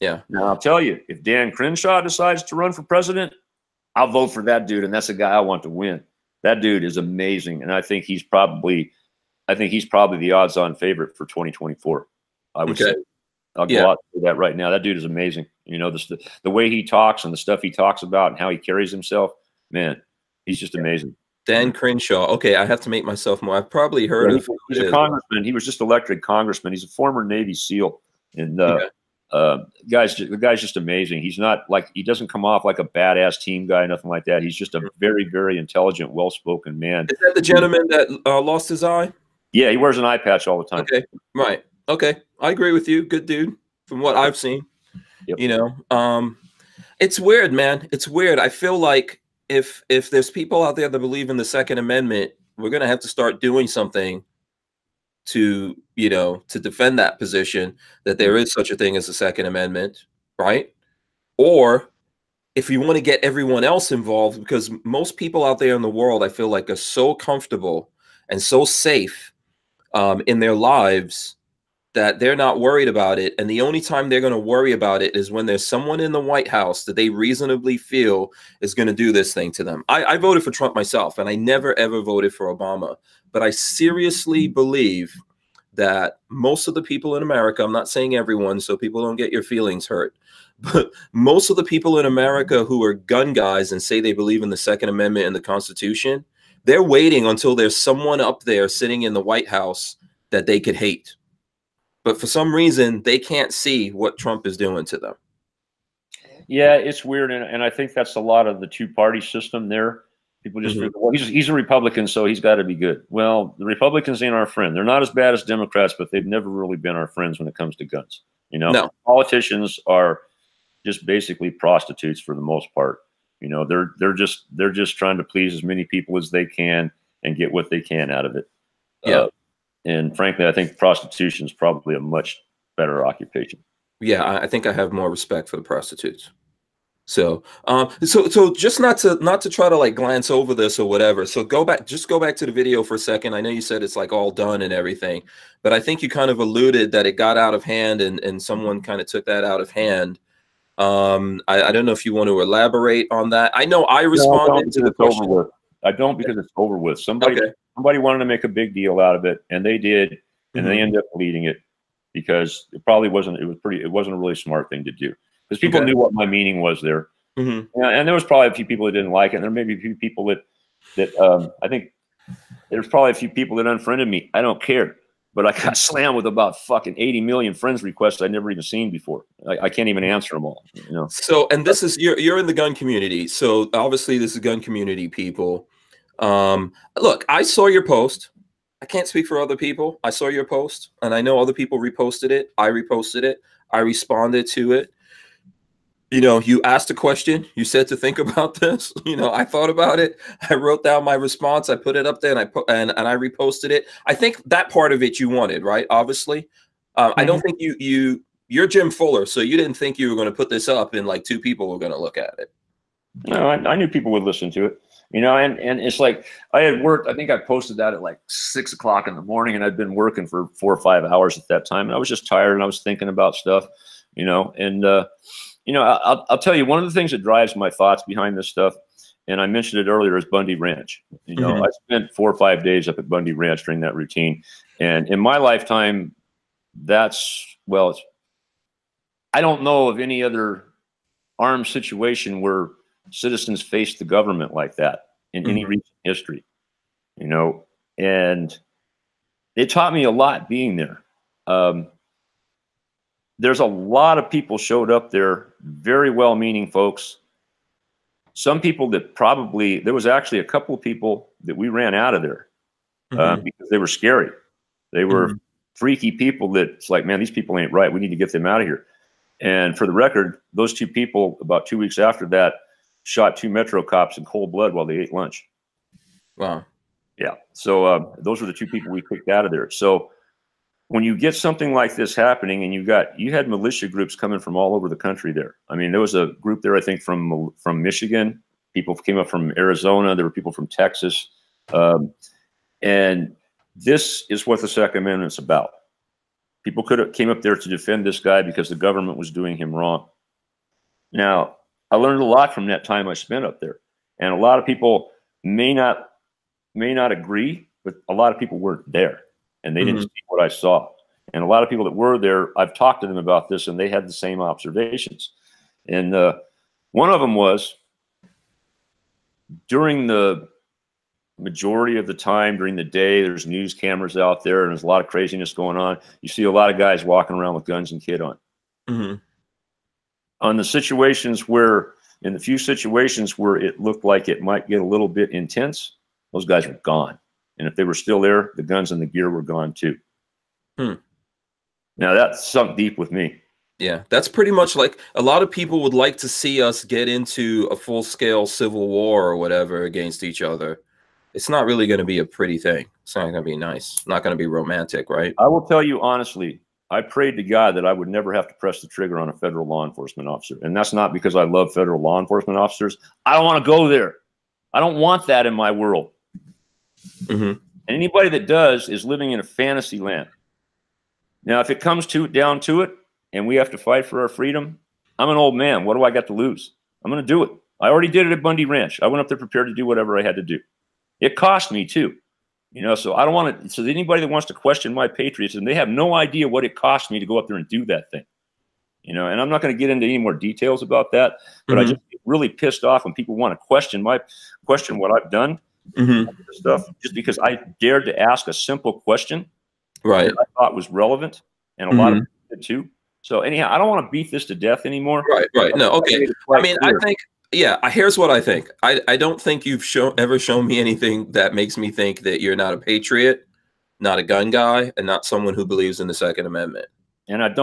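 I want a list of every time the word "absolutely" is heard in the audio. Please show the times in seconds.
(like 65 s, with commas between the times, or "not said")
not said.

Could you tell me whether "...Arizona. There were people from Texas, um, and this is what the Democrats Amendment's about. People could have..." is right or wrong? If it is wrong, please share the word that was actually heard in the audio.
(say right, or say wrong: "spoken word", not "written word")
wrong: "Second", not "Democrats".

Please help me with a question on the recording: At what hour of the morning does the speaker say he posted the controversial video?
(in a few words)
6 o'clock.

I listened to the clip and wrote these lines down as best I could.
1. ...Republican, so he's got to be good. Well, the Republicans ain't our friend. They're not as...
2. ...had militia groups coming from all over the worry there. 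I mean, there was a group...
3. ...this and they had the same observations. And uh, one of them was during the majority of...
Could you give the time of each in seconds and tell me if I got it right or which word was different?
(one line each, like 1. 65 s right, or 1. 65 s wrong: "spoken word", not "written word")
1. 111 s right
2. 283 s wrong: "country", not "worry"
3. 313 s right.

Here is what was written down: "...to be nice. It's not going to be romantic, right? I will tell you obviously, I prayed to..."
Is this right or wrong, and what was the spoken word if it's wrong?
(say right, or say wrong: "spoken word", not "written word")
wrong: "honestly", not "obviously".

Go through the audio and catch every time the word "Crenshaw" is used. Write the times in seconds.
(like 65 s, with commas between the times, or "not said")
1 s, 21 s.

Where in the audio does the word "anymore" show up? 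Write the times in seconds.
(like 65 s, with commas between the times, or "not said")
404 s.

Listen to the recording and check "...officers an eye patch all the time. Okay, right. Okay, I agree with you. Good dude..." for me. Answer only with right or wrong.
wrong.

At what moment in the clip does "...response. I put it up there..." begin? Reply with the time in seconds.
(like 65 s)
201 s.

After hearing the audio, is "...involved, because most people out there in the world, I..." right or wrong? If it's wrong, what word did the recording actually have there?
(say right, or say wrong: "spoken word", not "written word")
right.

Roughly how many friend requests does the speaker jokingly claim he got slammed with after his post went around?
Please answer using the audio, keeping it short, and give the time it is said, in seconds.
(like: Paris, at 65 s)
80 million, at 176 s.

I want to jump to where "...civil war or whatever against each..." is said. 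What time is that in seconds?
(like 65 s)
348 s.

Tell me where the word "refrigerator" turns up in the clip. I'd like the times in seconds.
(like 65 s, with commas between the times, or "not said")
not said.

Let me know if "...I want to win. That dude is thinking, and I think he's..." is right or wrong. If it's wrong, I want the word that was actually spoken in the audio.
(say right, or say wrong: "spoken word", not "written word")
wrong: "amazing", not "thinking".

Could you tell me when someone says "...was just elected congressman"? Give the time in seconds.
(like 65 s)
25 s.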